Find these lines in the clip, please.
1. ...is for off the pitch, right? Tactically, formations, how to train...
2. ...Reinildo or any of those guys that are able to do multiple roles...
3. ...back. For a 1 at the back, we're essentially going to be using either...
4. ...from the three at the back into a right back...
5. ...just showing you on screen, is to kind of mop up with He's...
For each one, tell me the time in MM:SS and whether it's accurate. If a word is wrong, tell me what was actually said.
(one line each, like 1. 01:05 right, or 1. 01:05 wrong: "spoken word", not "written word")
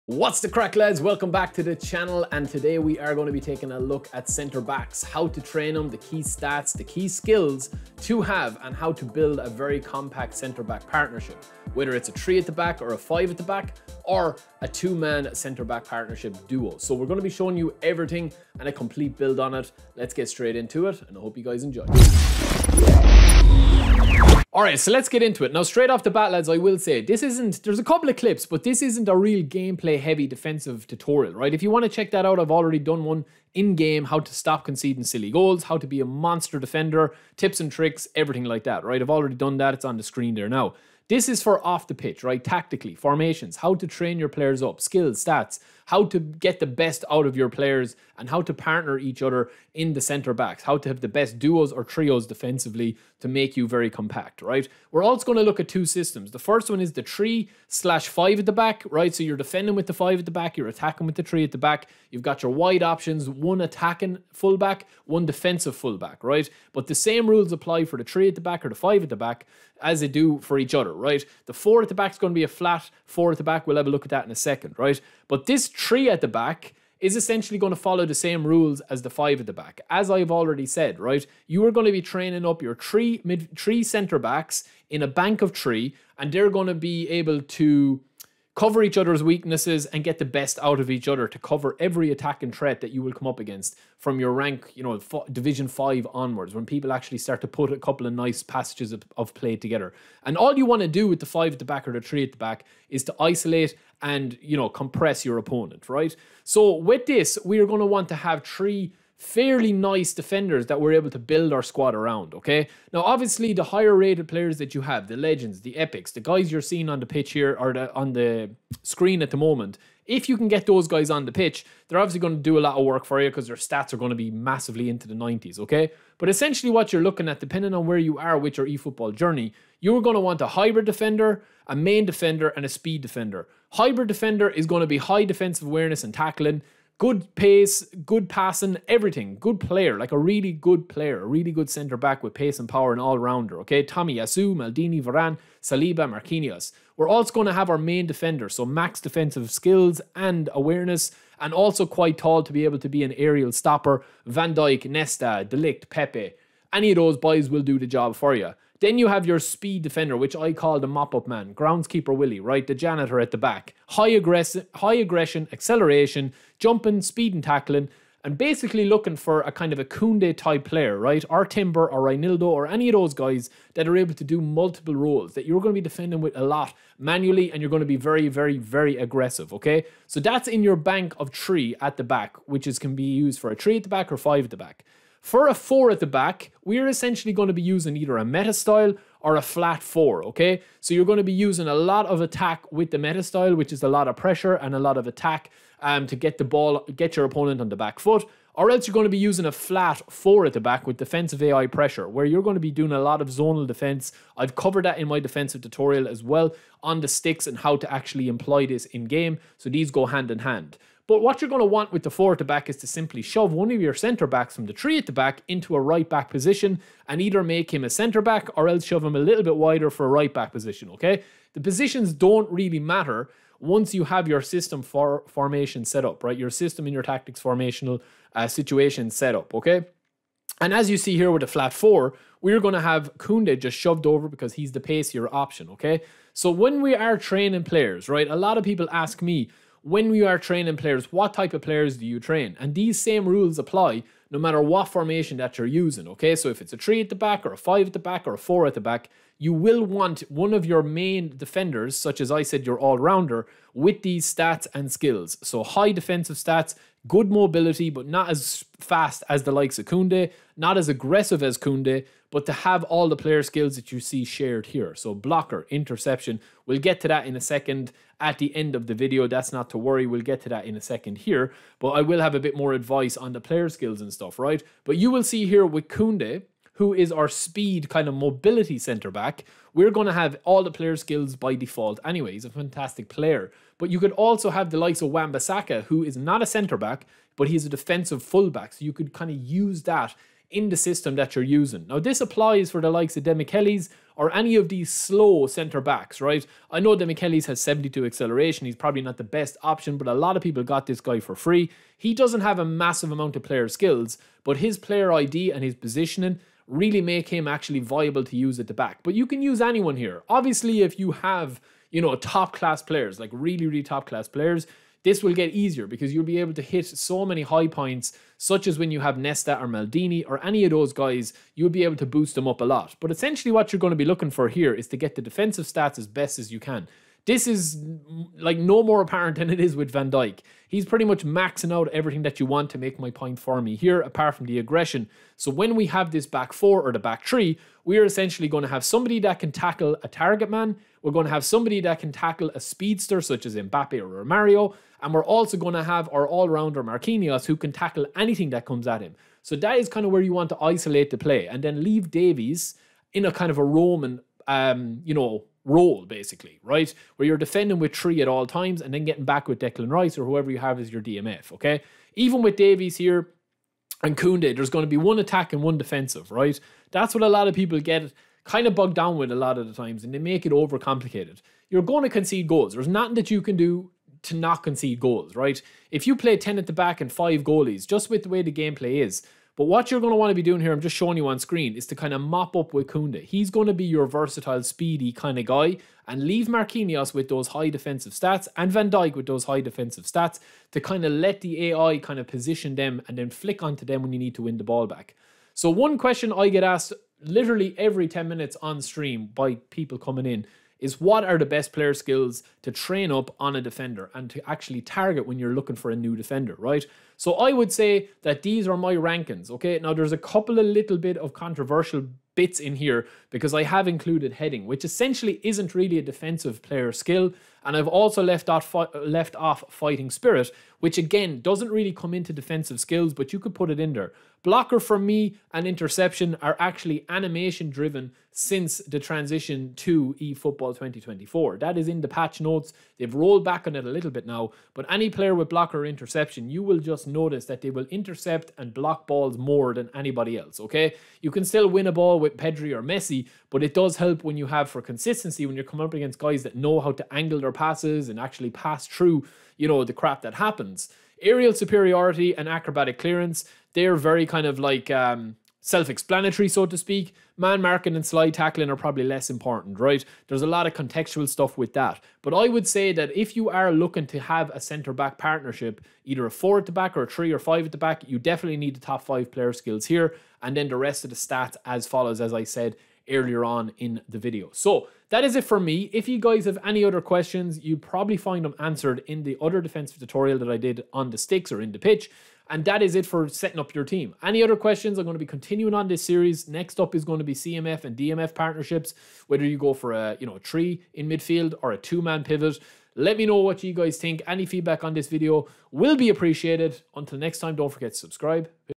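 1. 00:41 right
2. 02:52 right
3. 03:04 wrong: "4", not "1"
4. 03:34 right
5. 06:20 right.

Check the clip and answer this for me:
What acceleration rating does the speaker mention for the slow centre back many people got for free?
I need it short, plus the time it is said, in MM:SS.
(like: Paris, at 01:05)
72, at 04:57.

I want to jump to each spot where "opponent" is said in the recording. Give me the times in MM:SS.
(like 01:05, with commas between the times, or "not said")
01:45, 03:17.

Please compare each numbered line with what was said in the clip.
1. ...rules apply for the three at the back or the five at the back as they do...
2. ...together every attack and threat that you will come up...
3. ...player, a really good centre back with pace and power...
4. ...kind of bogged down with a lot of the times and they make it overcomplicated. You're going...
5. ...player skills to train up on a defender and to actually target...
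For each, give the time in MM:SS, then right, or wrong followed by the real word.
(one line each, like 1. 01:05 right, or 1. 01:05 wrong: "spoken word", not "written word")
1. 01:07 right
2. 01:31 wrong: "cover", not "together"
3. 02:20 right
4. 06:08 right
5. 06:41 right.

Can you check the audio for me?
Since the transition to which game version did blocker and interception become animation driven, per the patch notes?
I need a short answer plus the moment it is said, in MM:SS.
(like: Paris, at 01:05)
eFootball 2024, at 07:10.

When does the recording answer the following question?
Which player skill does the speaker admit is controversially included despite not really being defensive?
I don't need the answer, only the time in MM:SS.
06:54.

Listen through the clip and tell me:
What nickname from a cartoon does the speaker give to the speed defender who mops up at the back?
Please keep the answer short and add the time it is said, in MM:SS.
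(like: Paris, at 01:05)
Groundskeeper Willie, at 02:41.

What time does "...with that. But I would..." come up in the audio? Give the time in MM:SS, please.
07:41.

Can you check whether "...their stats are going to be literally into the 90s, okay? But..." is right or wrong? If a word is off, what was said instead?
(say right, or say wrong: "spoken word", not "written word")
wrong: "massively", not "literally".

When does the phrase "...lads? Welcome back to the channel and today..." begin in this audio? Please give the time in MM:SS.
00:00.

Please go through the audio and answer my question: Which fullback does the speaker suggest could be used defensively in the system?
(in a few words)
Wan-Bissaka.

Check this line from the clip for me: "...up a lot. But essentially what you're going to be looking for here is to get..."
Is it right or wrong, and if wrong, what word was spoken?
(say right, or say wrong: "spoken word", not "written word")
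right.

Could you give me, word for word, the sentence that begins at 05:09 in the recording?
But you can use anyone here.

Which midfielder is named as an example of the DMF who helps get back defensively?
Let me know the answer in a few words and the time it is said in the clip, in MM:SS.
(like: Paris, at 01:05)
Declan Rice, at 05:59.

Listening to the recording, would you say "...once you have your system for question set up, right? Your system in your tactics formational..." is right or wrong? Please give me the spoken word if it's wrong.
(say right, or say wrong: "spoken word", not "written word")
wrong: "formation", not "question".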